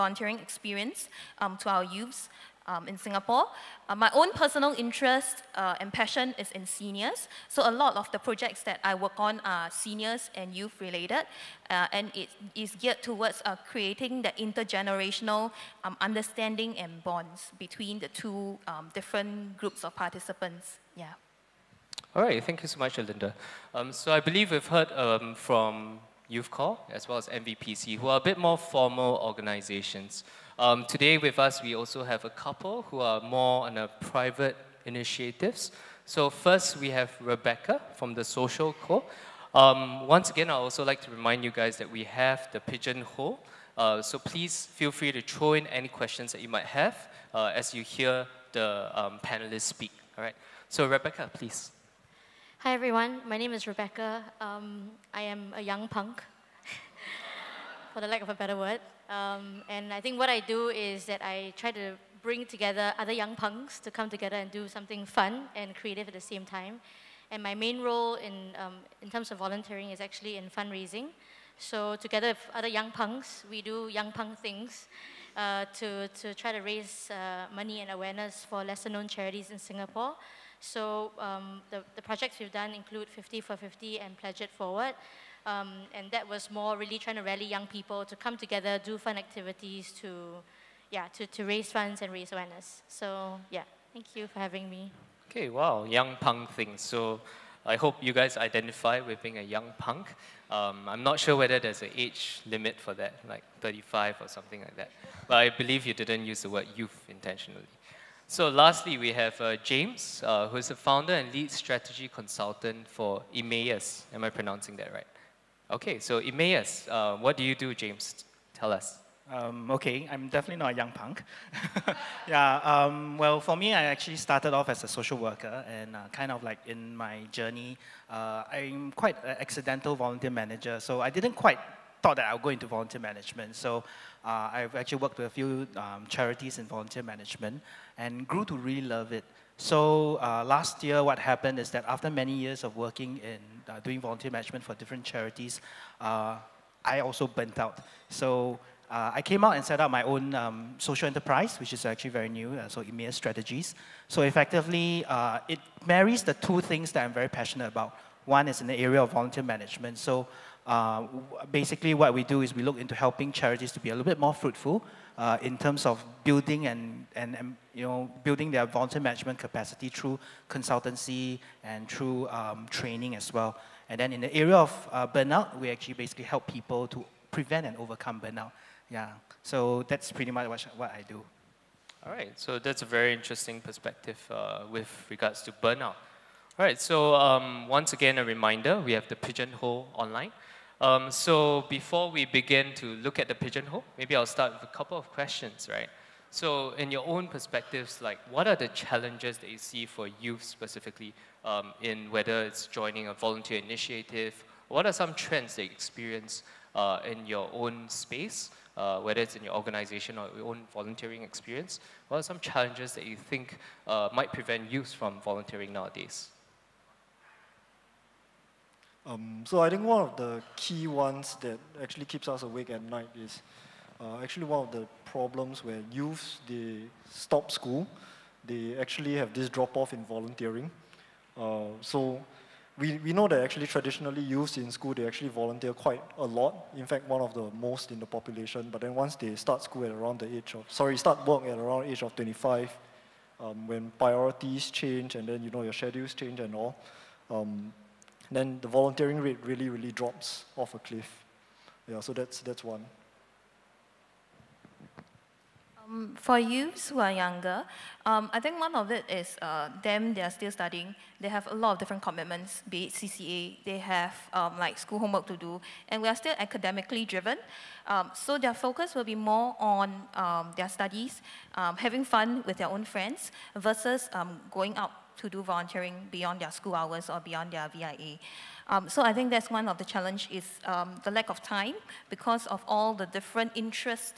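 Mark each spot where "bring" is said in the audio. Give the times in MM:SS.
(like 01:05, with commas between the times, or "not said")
01:02.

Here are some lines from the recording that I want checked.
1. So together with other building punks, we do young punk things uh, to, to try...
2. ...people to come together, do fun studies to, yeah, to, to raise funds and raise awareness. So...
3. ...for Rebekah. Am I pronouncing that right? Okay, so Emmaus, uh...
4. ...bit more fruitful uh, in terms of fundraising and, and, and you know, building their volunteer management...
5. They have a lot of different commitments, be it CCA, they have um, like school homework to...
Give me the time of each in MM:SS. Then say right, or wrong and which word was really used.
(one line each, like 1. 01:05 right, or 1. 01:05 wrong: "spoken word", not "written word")
1. 01:11 wrong: "young", not "building"
2. 01:27 wrong: "activities", not "studies"
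3. 01:52 wrong: "Emmaus", not "Rebekah"
4. 02:44 wrong: "building", not "fundraising"
5. 04:21 right.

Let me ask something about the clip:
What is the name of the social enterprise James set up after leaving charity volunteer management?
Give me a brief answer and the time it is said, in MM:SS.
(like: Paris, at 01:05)
Emmaus Strategies, at 02:32.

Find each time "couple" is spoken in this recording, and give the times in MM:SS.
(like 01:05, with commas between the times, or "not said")
00:32, 03:14.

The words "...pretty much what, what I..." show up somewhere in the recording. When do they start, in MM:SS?
03:00.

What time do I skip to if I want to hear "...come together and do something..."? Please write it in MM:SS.
01:03.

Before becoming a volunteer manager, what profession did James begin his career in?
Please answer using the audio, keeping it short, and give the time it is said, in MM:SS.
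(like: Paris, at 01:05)
Social worker, at 02:04.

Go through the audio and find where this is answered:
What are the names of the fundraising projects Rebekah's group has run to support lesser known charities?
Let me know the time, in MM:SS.
01:23.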